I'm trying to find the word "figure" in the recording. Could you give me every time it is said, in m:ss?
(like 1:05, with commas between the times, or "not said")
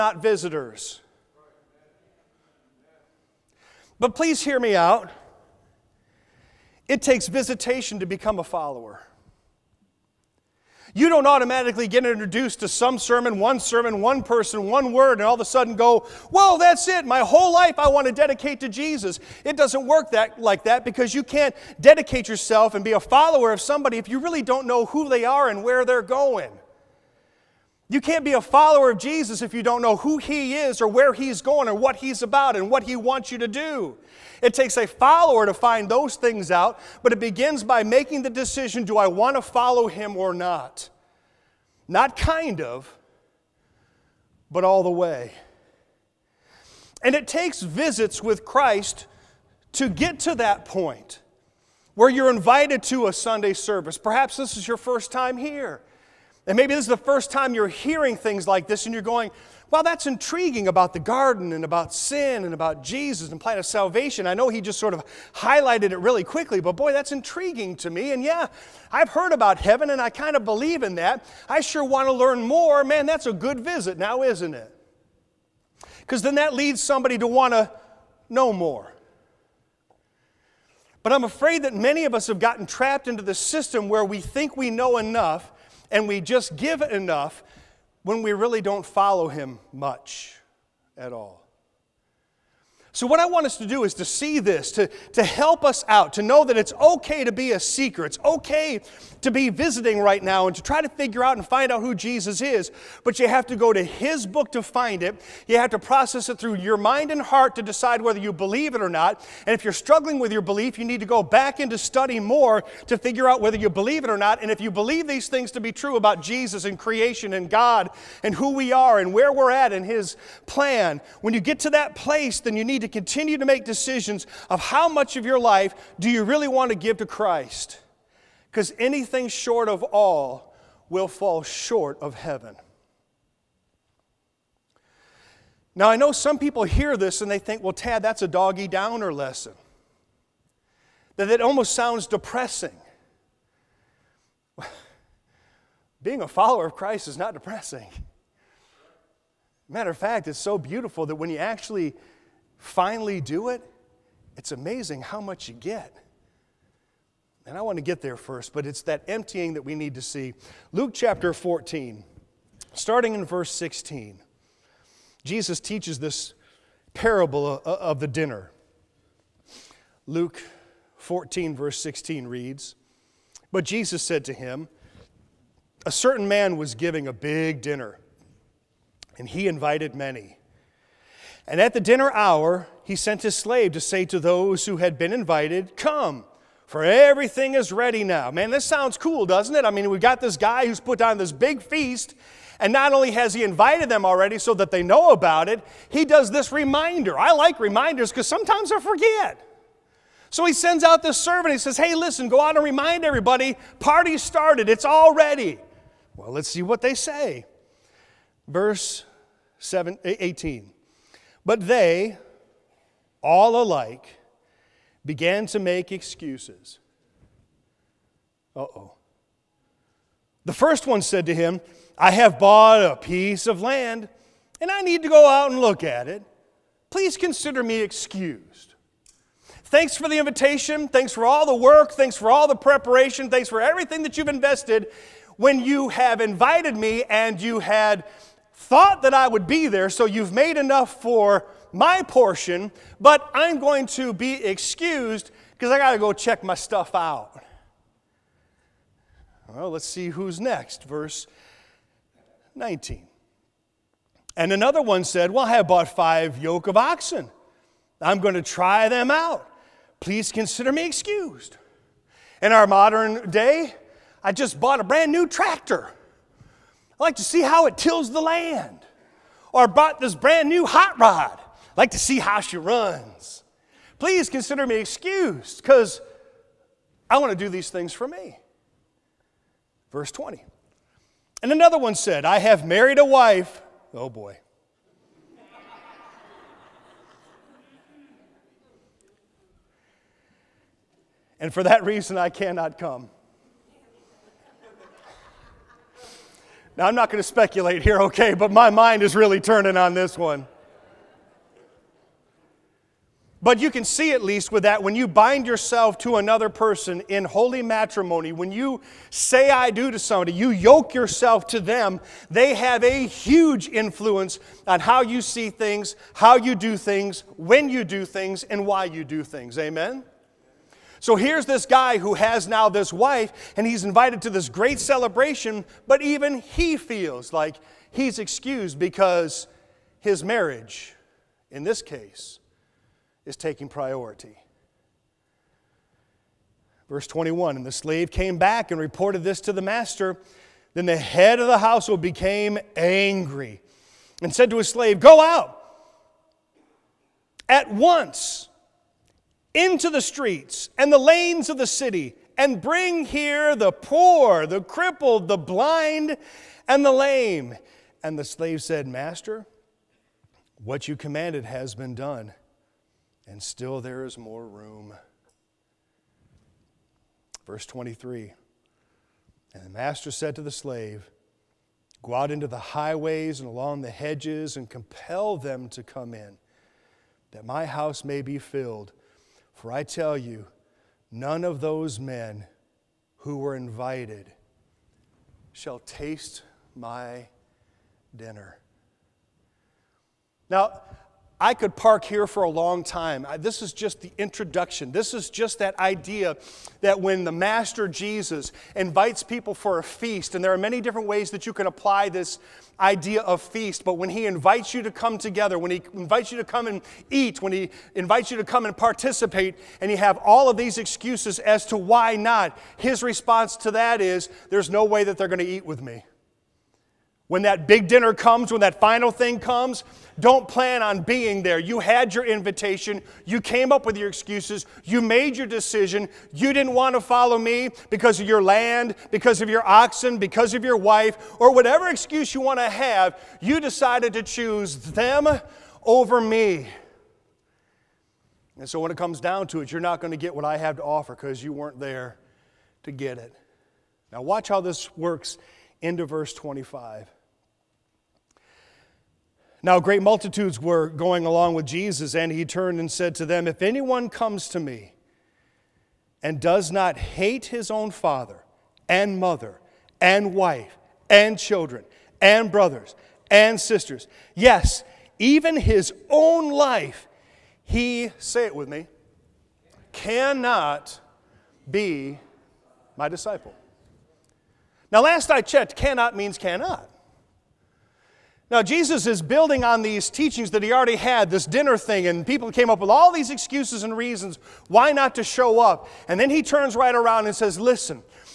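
1:40, 1:52.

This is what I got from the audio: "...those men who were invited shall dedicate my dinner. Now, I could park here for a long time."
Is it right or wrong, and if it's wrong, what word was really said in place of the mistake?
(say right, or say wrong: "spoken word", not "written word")
wrong: "taste", not "dedicate".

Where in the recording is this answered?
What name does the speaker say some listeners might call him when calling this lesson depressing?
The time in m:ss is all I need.
2:17.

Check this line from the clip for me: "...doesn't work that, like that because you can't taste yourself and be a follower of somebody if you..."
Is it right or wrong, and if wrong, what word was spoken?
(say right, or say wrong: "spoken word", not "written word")
wrong: "dedicate", not "taste".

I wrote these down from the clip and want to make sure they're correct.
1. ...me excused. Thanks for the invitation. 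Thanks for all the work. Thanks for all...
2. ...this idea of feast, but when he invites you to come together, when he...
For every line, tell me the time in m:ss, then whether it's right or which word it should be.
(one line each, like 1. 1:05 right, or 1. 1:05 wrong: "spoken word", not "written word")
1. 3:47 right
2. 6:42 right.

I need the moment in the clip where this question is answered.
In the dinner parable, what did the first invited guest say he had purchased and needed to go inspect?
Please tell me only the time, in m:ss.
3:42.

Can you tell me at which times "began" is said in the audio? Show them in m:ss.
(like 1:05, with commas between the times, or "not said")
3:35.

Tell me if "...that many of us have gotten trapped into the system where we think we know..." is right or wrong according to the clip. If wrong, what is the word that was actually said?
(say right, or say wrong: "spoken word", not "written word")
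right.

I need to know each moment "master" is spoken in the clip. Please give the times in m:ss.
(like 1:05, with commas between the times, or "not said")
5:39, 5:58, 6:09, 6:37.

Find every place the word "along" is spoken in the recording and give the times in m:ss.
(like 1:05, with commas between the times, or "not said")
6:13, 7:31.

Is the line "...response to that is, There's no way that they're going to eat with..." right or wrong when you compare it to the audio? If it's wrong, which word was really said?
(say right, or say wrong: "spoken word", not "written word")
right.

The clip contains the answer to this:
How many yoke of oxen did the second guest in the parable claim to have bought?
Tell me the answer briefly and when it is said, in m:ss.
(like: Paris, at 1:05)
5, at 4:15.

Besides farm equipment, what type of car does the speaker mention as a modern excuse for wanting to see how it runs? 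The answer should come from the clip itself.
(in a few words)
Hot rod.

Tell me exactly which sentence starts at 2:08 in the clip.
Because anything short of all will fall short of heaven.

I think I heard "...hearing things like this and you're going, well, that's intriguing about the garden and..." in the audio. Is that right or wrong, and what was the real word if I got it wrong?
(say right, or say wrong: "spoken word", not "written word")
right.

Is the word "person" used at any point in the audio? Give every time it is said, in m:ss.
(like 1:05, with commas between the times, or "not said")
0:14, 5:06.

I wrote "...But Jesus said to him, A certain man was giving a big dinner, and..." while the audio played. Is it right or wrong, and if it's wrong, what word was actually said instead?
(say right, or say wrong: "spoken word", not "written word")
right.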